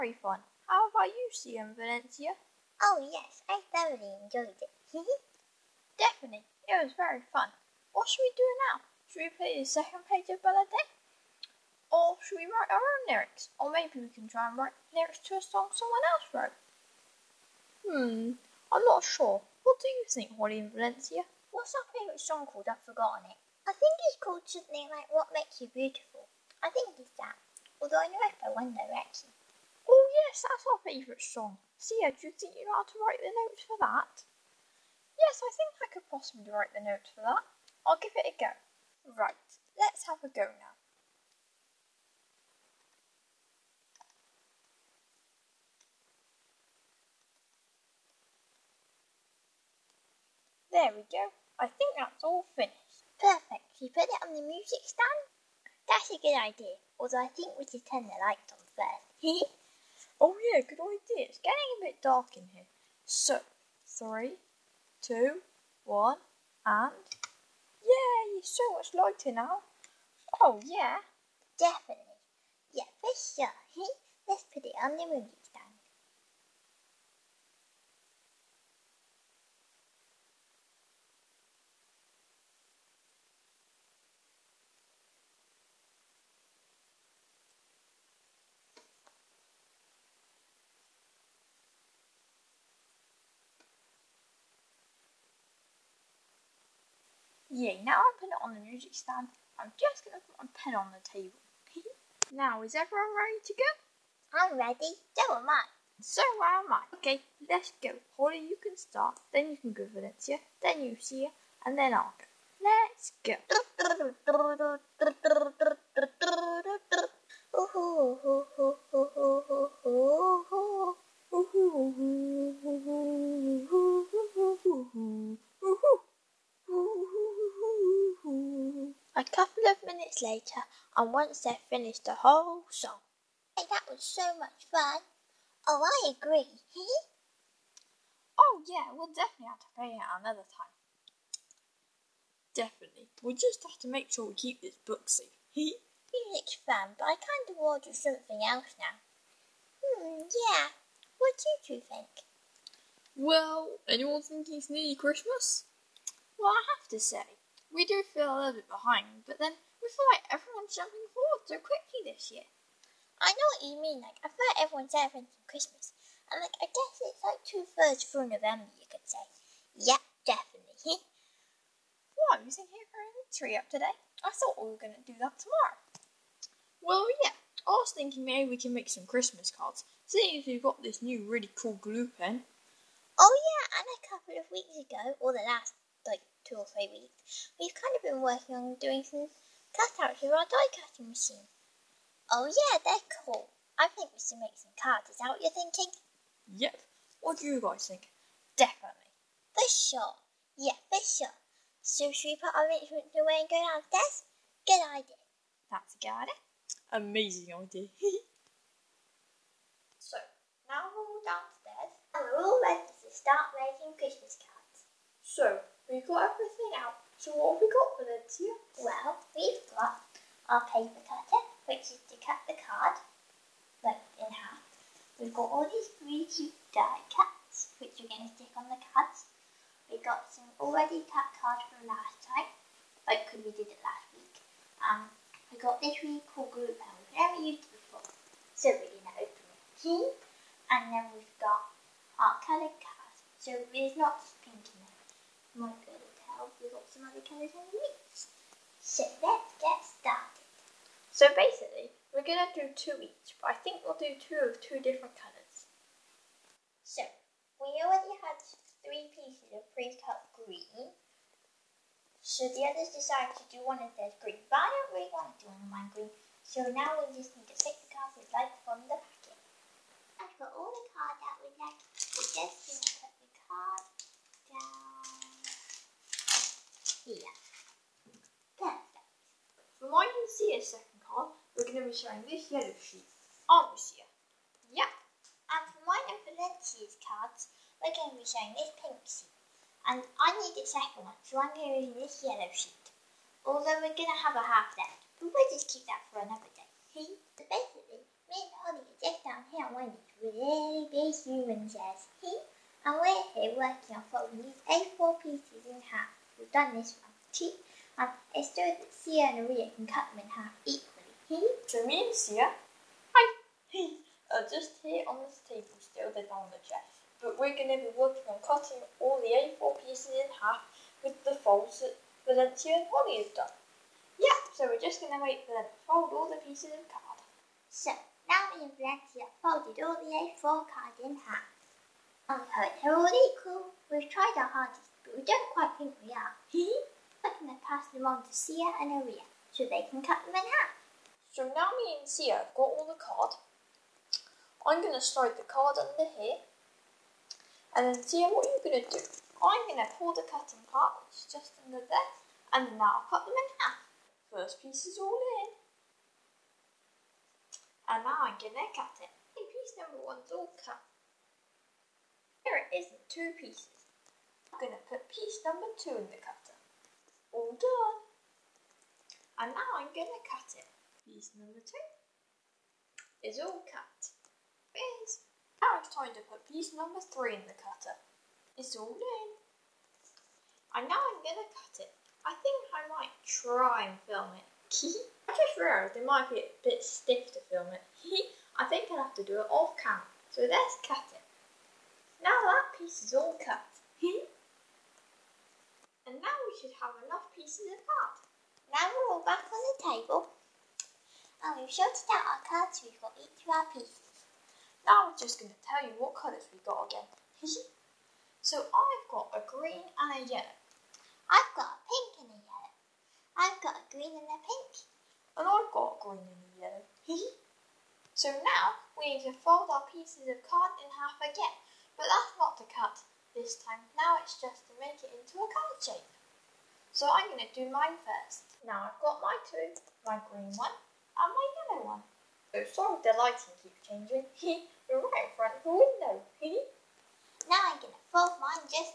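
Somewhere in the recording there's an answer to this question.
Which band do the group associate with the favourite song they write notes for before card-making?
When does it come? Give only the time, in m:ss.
0:28.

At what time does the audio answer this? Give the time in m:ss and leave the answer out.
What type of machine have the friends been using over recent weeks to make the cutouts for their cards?
3:10.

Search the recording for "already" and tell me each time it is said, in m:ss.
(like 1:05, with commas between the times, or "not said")
3:50, 4:17.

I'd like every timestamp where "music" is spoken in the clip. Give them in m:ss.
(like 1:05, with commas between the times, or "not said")
0:54, 1:15, 1:38, 2:25.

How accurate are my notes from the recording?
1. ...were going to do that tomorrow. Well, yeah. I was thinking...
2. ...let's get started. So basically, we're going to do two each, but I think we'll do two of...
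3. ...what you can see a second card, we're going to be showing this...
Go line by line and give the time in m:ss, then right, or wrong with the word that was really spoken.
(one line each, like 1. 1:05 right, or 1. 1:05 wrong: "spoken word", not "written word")
1. 2:54 right
2. 4:09 right
3. 4:39 right.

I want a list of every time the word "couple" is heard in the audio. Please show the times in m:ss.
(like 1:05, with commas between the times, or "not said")
2:09, 3:04.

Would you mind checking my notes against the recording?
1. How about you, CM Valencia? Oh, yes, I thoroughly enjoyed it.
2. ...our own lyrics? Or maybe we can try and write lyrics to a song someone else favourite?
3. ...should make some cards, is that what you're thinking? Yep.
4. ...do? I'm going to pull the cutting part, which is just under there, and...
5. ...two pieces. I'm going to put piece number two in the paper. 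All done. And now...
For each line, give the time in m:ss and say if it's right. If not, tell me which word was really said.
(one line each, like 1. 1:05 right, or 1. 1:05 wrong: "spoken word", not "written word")
1. 0:00 right
2. 0:12 wrong: "wrote", not "favourite"
3. 3:14 right
4. 5:48 right
5. 6:03 wrong: "cutter", not "paper".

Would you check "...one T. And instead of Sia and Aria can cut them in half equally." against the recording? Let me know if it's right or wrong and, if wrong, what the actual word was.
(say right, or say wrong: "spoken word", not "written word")
right.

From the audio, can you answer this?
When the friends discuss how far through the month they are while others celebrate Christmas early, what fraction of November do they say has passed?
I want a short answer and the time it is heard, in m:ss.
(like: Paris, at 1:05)
Two thirds, at 2:47.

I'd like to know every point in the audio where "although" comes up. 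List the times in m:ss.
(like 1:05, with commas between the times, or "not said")
0:27, 0:56, 4:53.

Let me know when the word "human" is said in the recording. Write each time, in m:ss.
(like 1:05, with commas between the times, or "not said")
5:01.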